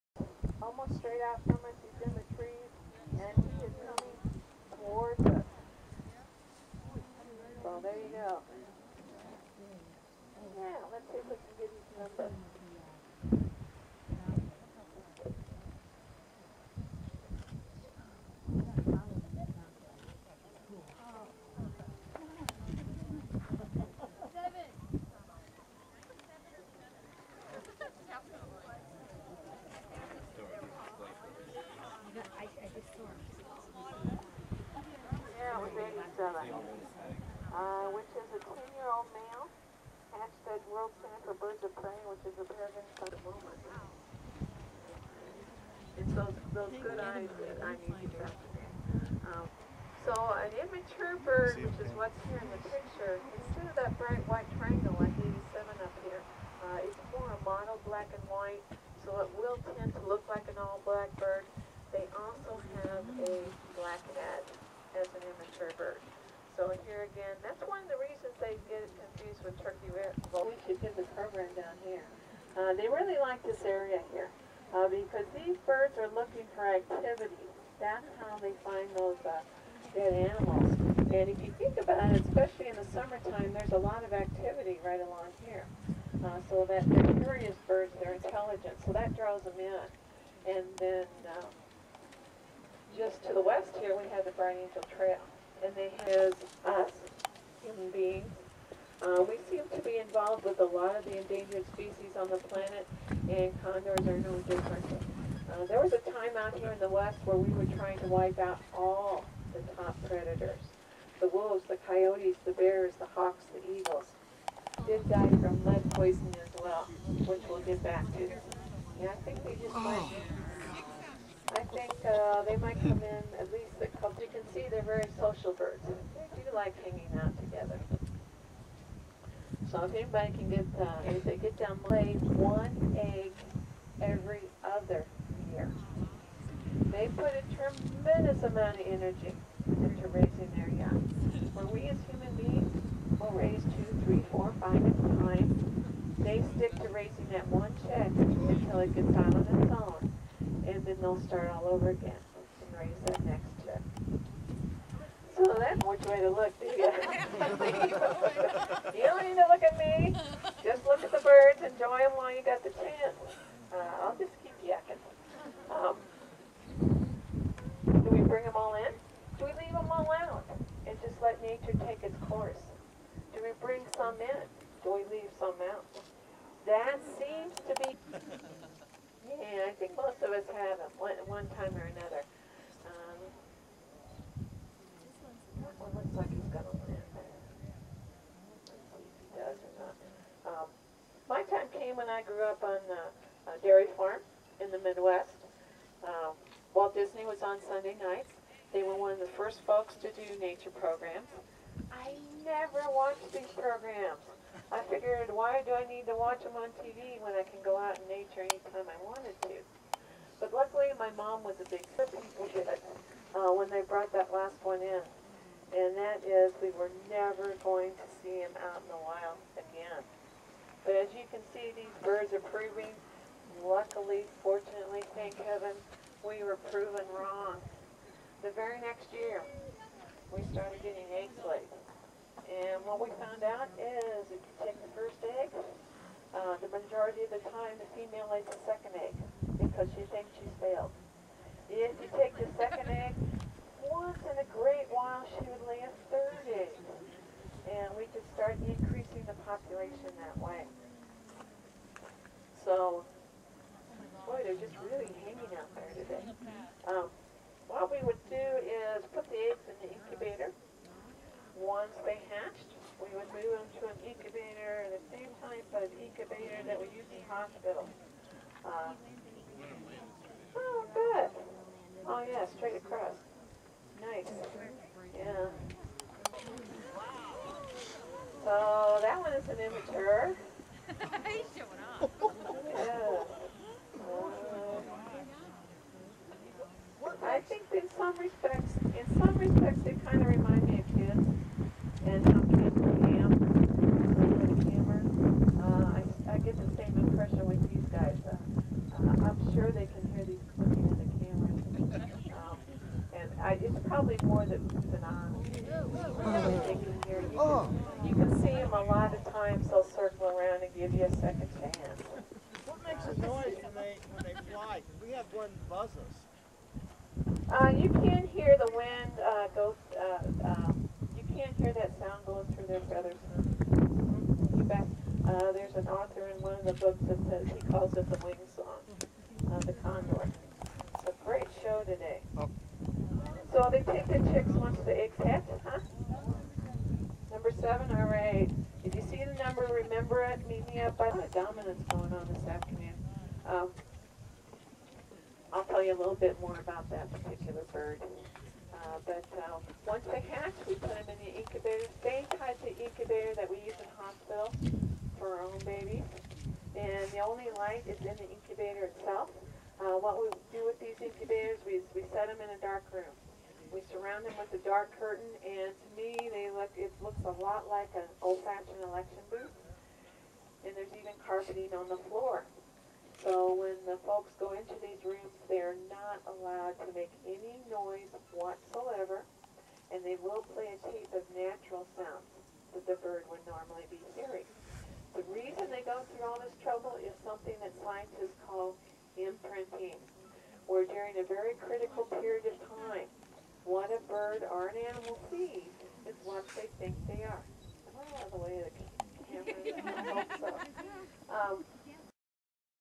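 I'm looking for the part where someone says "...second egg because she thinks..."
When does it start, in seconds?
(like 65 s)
238 s.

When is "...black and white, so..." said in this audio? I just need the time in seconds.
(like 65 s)
57 s.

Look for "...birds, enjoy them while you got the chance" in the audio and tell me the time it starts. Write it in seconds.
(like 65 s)
161 s.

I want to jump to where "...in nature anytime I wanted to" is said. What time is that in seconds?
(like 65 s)
207 s.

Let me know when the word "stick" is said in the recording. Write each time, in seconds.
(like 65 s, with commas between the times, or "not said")
146 s.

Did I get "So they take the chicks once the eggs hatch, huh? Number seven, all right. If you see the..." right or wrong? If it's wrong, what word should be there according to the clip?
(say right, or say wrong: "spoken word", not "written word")
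right.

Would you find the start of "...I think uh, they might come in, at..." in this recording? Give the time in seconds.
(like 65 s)
121 s.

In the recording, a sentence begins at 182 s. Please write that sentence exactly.
Um, that one looks like he's going to win.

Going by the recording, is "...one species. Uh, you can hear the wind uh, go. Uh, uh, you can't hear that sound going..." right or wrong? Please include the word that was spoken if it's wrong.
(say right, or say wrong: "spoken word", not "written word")
wrong: "buzzes", not "species".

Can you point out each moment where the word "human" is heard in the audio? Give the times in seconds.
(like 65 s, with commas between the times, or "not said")
97 s, 142 s.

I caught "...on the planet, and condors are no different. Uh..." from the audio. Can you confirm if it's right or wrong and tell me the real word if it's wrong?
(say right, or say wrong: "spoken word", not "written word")
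right.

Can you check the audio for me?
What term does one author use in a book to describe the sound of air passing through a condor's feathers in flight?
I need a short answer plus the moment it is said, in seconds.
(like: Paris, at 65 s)
wing song, at 328 s.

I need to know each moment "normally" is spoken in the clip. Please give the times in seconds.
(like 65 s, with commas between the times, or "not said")
383 s.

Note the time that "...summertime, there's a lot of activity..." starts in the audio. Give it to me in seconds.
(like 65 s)
82 s.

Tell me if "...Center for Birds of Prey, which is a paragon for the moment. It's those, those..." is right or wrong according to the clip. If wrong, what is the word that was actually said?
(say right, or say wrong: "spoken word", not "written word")
right.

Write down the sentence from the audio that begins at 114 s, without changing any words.
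Did die from lead poisoning as well, which we'll get back to.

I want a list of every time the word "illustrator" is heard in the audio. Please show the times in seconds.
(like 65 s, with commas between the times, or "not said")
not said.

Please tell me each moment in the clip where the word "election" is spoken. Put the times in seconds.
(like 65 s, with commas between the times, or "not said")
368 s.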